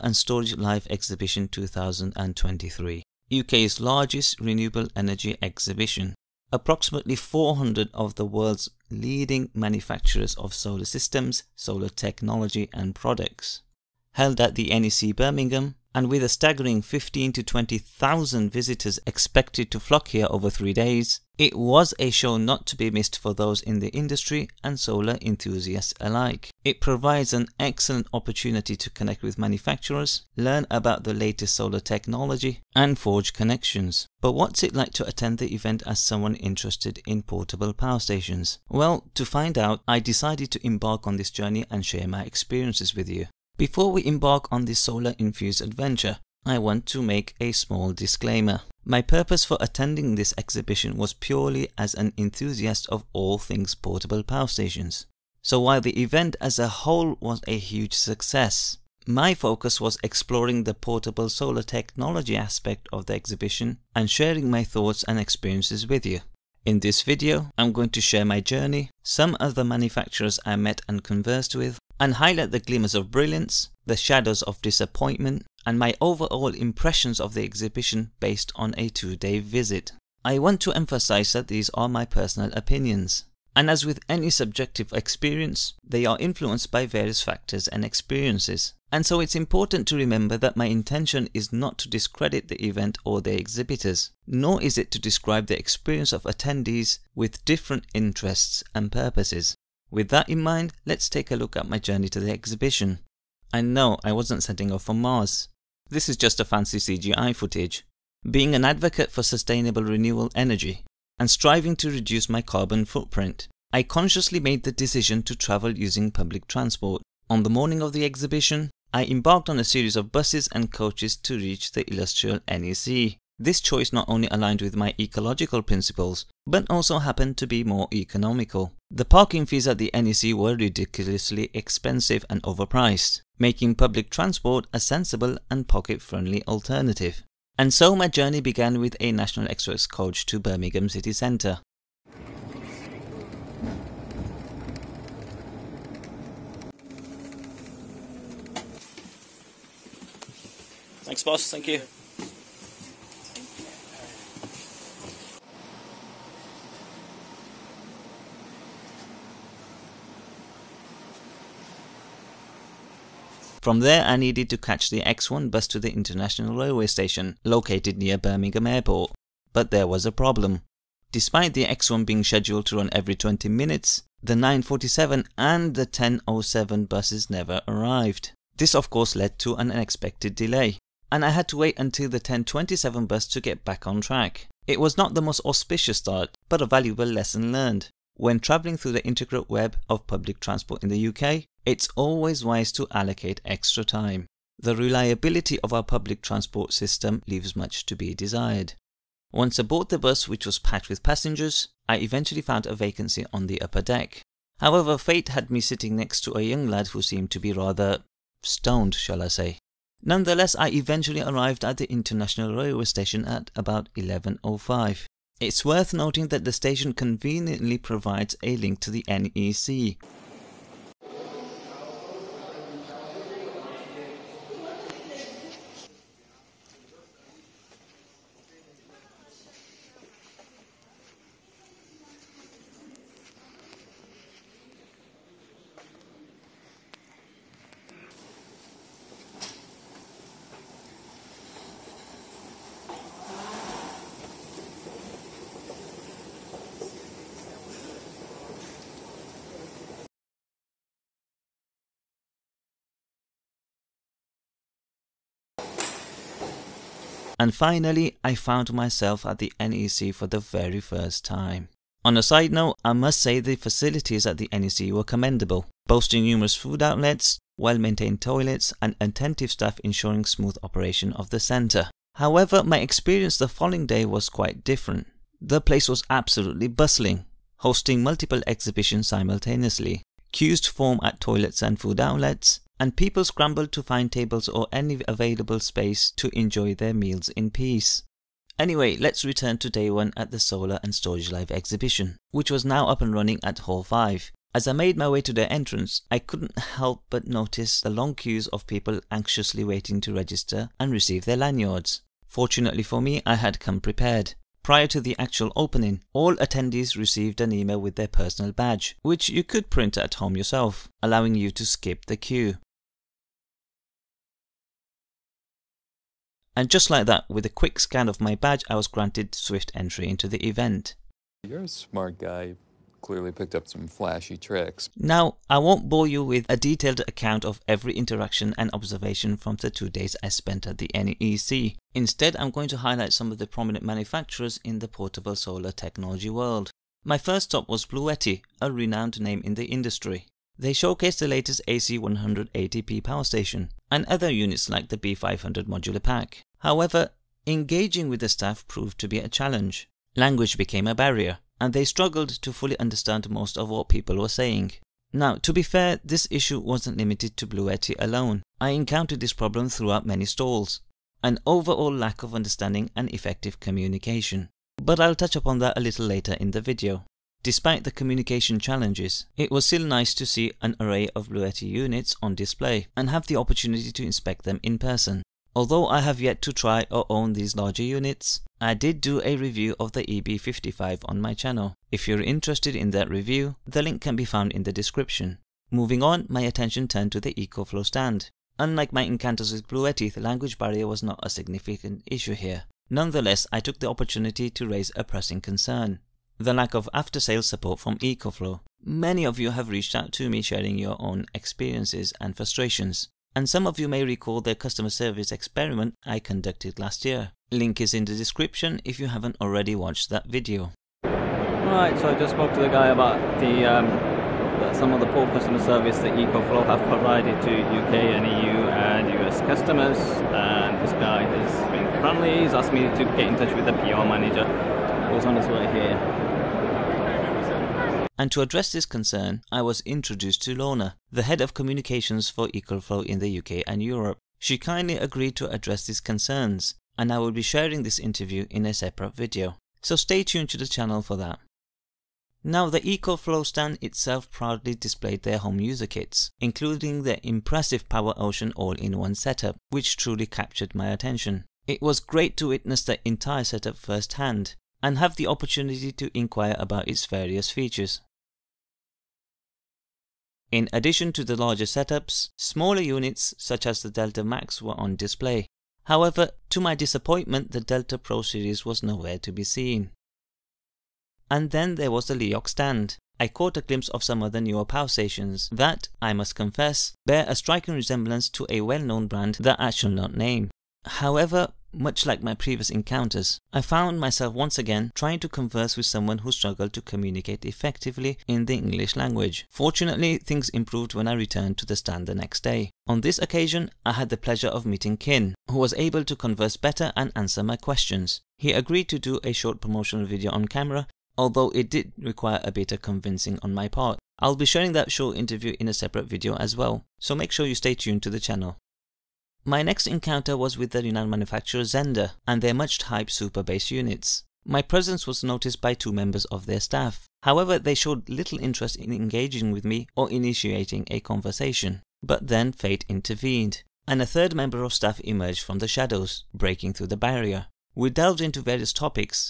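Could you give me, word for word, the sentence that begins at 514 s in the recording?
My presence was noticed by two members of their staff.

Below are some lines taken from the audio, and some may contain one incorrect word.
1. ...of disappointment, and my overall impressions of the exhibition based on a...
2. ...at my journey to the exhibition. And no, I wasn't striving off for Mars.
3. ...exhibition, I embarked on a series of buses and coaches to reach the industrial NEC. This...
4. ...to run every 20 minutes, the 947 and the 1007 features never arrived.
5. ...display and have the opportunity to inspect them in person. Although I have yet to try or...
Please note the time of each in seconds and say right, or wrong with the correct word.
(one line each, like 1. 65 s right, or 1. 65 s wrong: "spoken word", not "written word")
1. 74 s right
2. 101 s wrong: "setting", not "striving"
3. 118 s right
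4. 172 s wrong: "buses", not "features"
5. 372 s right.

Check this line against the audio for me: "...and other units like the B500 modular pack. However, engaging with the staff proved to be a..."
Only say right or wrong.
right.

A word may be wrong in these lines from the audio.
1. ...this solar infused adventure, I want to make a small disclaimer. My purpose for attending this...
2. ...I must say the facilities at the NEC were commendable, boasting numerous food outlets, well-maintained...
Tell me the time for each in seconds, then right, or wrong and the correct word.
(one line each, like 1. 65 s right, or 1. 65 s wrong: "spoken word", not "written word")
1. 44 s right
2. 262 s right.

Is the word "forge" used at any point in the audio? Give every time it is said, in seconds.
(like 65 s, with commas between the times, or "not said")
32 s.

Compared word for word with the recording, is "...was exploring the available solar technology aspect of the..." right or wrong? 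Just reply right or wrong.
wrong.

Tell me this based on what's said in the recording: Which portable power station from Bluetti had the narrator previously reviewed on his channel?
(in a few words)
EB55.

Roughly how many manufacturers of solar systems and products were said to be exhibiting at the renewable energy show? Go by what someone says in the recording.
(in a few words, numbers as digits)
400.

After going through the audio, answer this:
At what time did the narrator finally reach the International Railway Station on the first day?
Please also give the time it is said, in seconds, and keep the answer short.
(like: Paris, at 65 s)
11.05, at 213 s.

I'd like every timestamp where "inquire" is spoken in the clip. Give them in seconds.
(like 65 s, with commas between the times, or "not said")
456 s.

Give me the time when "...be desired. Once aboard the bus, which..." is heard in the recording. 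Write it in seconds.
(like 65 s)
197 s.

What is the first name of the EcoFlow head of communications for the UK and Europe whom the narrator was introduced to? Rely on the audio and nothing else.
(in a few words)
Lorna.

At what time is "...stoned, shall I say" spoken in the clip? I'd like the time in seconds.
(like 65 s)
208 s.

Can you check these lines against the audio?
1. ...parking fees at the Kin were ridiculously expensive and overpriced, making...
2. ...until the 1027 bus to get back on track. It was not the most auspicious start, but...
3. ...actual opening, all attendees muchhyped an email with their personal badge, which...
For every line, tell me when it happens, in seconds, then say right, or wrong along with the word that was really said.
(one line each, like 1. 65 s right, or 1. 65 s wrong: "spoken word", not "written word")
1. 129 s wrong: "NEC", not "Kin"
2. 181 s right
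3. 305 s wrong: "received", not "muchhyped".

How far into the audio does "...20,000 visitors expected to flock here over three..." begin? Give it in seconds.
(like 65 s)
17 s.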